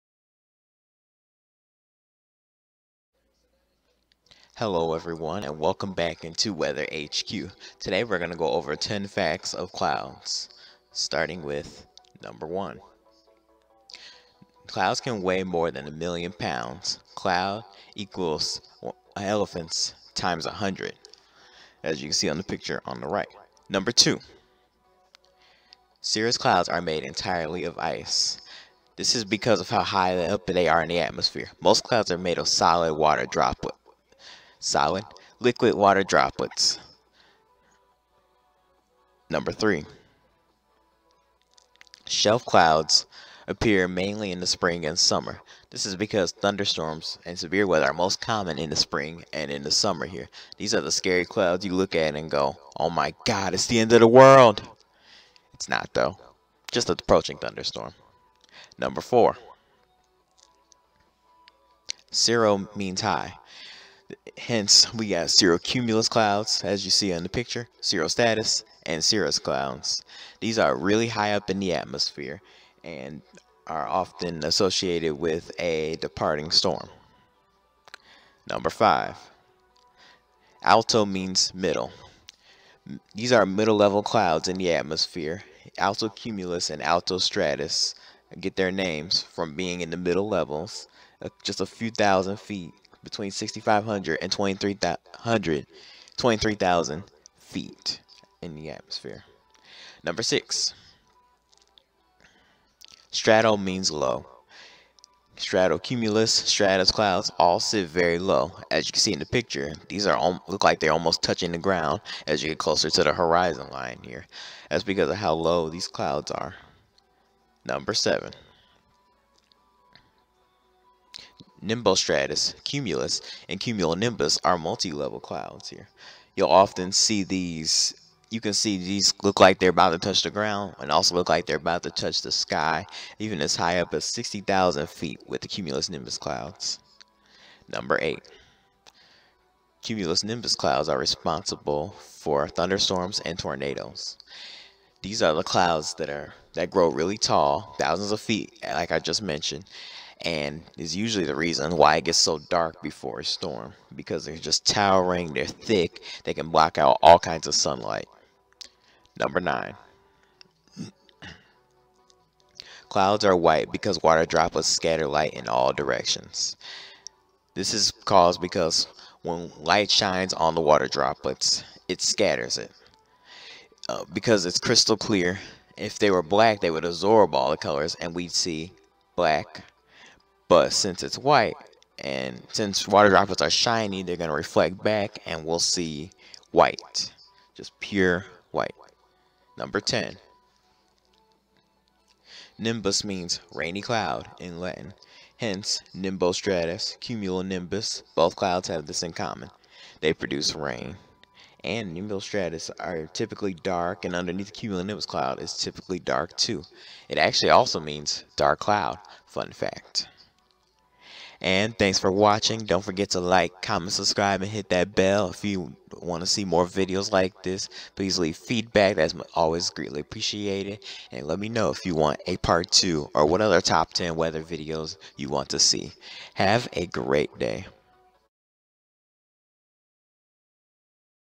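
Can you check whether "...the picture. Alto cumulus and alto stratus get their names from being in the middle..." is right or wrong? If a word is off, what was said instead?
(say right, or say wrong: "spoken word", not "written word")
wrong: "atmosphere", not "picture".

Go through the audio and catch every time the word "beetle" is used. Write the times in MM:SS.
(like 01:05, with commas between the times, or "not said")
not said.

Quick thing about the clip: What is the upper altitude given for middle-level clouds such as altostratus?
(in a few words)
23,000 feet.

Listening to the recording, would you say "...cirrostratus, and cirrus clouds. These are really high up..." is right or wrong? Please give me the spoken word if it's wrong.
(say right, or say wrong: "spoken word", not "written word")
right.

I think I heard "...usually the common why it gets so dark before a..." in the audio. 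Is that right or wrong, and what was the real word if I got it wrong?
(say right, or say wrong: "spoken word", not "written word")
wrong: "reason", not "common".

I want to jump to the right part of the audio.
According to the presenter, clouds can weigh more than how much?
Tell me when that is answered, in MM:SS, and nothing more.
00:15.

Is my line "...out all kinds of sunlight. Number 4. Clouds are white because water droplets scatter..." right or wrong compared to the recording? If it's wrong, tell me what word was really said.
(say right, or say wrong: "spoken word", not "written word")
wrong: "9", not "4".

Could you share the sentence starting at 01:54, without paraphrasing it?
That's because of how low these clouds are.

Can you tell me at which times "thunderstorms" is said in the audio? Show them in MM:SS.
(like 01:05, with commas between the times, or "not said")
00:46, 00:57, 02:22.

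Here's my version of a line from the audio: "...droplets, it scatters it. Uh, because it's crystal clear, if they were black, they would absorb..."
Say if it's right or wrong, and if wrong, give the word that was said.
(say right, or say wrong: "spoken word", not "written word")
right.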